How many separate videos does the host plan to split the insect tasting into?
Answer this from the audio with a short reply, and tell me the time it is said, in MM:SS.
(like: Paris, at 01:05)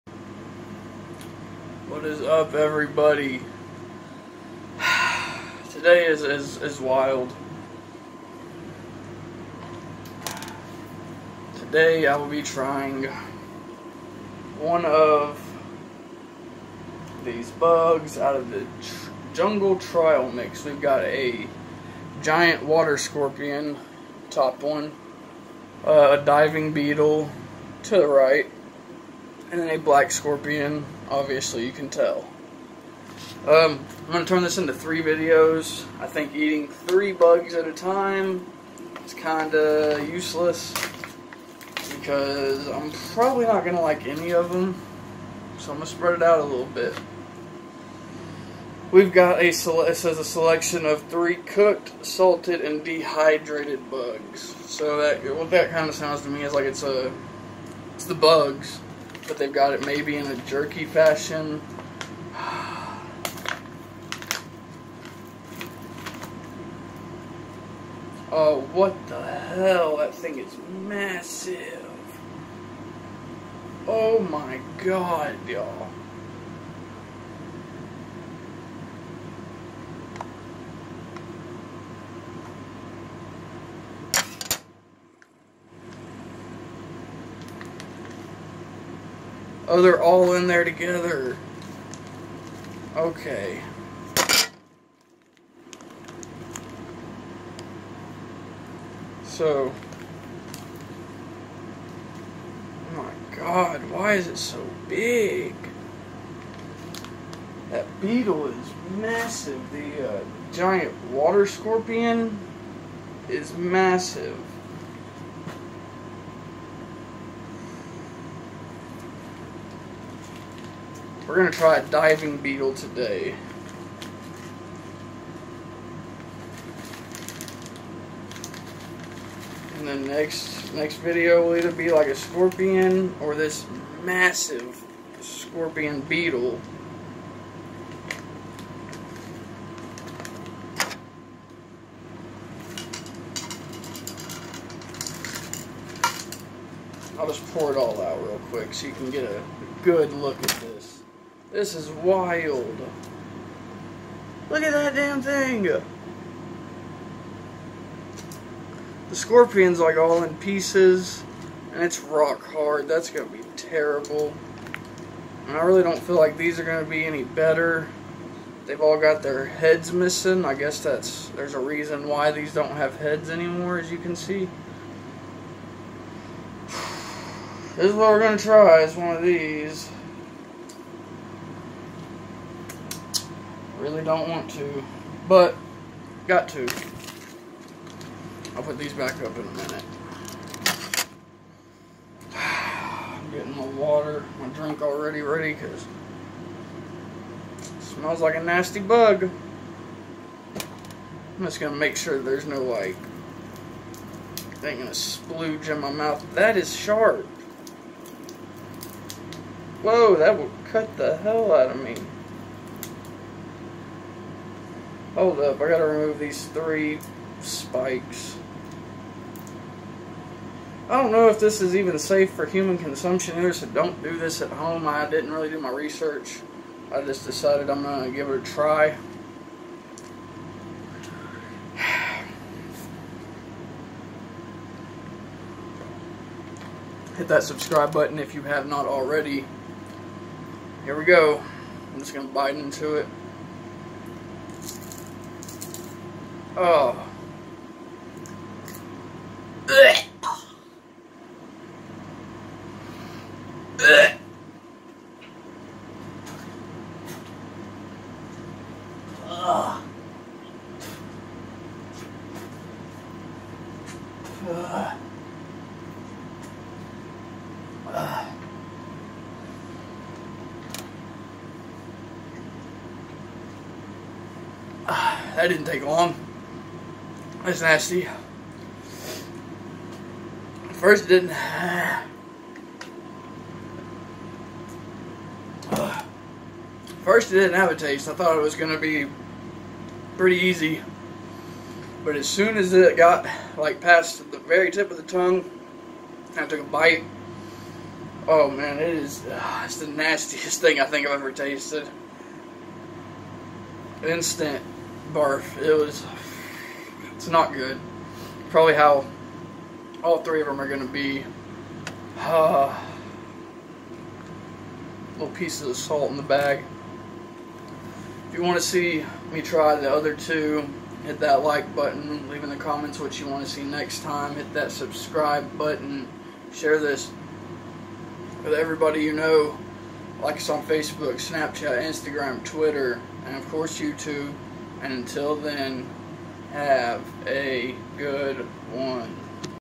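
3, at 00:34.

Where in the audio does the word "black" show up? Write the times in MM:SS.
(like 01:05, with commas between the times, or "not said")
00:29.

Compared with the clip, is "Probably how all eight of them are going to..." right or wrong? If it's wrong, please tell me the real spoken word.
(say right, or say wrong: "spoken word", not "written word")
wrong: "three", not "eight".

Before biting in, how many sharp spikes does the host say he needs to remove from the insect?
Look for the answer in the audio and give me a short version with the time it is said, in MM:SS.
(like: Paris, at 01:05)
3, at 03:36.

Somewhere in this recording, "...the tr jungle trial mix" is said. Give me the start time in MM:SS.
00:18.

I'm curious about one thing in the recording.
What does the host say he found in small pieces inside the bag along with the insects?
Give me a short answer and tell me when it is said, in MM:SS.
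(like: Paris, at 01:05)
Salt, at 05:15.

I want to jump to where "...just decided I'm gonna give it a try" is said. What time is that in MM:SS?
03:47.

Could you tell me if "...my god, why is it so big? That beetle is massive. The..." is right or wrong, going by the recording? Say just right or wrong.
right.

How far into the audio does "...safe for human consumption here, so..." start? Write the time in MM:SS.
03:41.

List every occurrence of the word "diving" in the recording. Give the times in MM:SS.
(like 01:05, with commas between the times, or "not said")
00:26, 02:01.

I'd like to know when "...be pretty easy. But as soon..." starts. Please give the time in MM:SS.
04:48.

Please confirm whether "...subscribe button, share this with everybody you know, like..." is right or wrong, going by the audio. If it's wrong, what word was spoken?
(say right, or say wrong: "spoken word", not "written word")
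right.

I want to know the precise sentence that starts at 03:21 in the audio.
I'm just going to make sure there's no like thing gonna splooge in my mouth.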